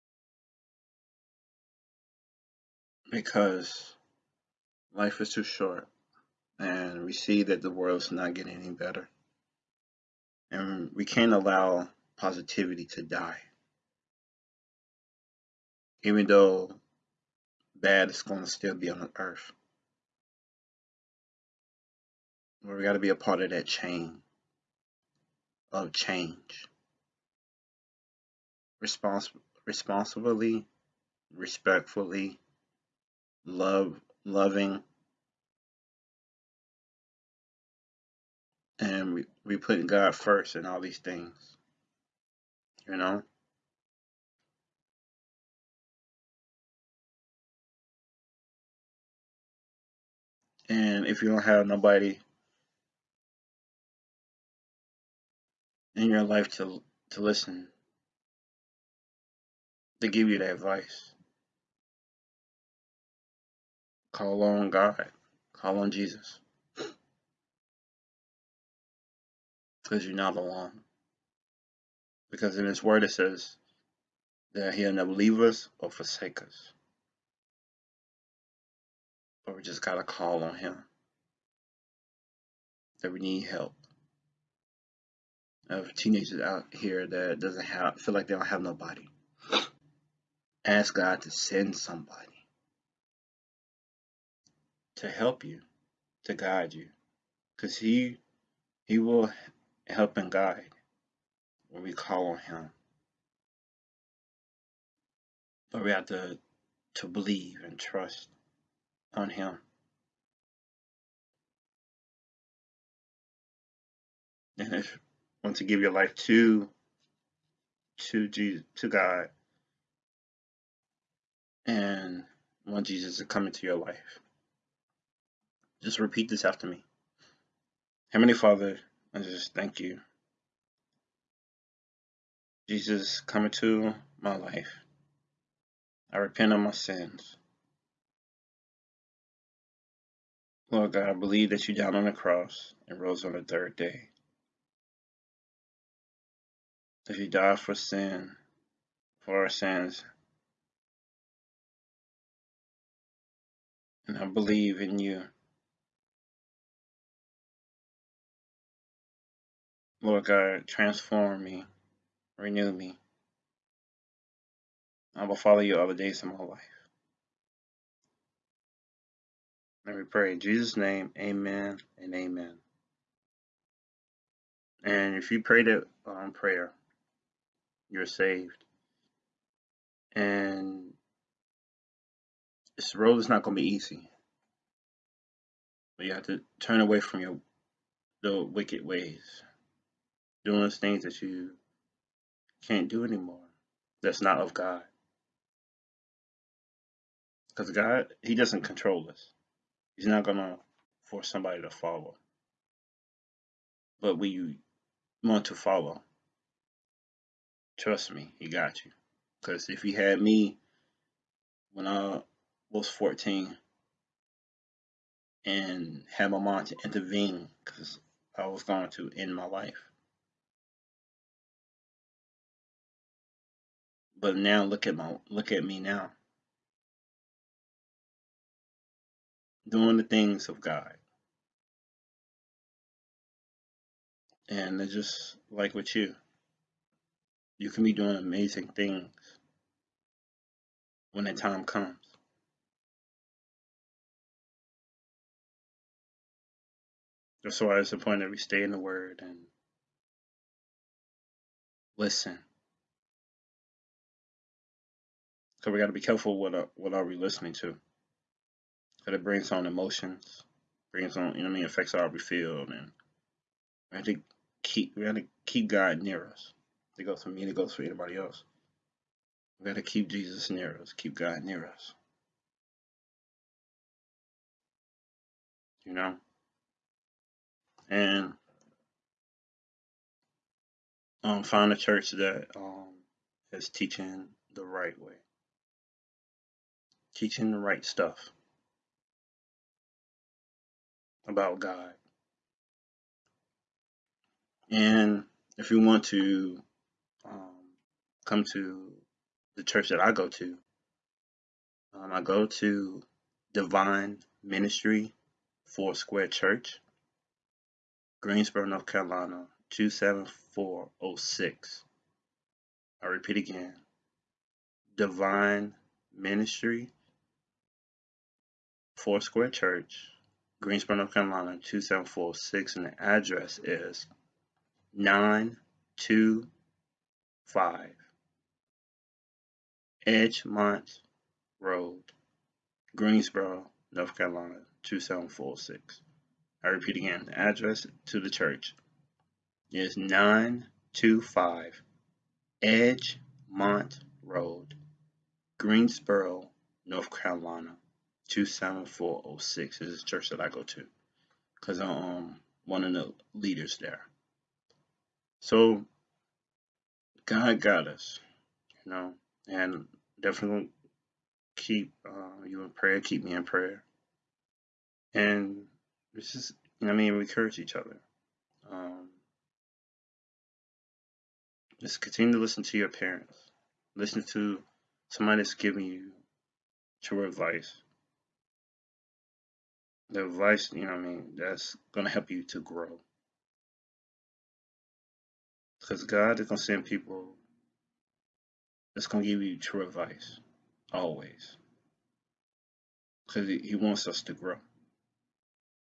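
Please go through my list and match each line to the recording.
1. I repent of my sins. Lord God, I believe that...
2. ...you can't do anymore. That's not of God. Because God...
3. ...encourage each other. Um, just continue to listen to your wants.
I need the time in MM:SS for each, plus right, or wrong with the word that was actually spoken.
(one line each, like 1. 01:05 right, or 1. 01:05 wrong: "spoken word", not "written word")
1. 02:16 right
2. 03:11 right
3. 06:07 wrong: "parents", not "wants".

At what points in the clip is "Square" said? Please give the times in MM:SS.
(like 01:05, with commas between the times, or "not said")
05:05, 05:19.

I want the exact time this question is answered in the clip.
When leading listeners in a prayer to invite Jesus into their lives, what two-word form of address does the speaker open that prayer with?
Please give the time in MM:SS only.
02:08.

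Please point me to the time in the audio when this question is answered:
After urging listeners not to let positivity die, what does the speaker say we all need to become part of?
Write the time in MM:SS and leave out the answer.
00:23.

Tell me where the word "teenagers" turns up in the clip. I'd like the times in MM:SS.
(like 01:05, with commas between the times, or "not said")
01:25.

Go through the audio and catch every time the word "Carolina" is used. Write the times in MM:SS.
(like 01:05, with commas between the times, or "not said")
05:08, 05:21, 05:34, 05:47.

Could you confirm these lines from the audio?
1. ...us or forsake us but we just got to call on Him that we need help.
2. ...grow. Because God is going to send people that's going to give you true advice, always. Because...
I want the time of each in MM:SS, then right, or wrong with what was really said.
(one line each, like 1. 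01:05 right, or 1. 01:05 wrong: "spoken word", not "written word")
1. 01:15 right
2. 06:22 right.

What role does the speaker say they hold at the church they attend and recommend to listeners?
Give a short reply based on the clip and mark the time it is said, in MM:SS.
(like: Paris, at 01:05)
one of the leaders, at 05:52.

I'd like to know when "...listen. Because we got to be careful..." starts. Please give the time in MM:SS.
04:11.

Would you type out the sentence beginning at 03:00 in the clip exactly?
And this road is not going to be easy.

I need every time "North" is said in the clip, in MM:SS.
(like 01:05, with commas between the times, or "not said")
05:08, 05:20, 05:33, 05:46.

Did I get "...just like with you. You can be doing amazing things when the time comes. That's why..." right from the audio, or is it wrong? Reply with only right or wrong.
right.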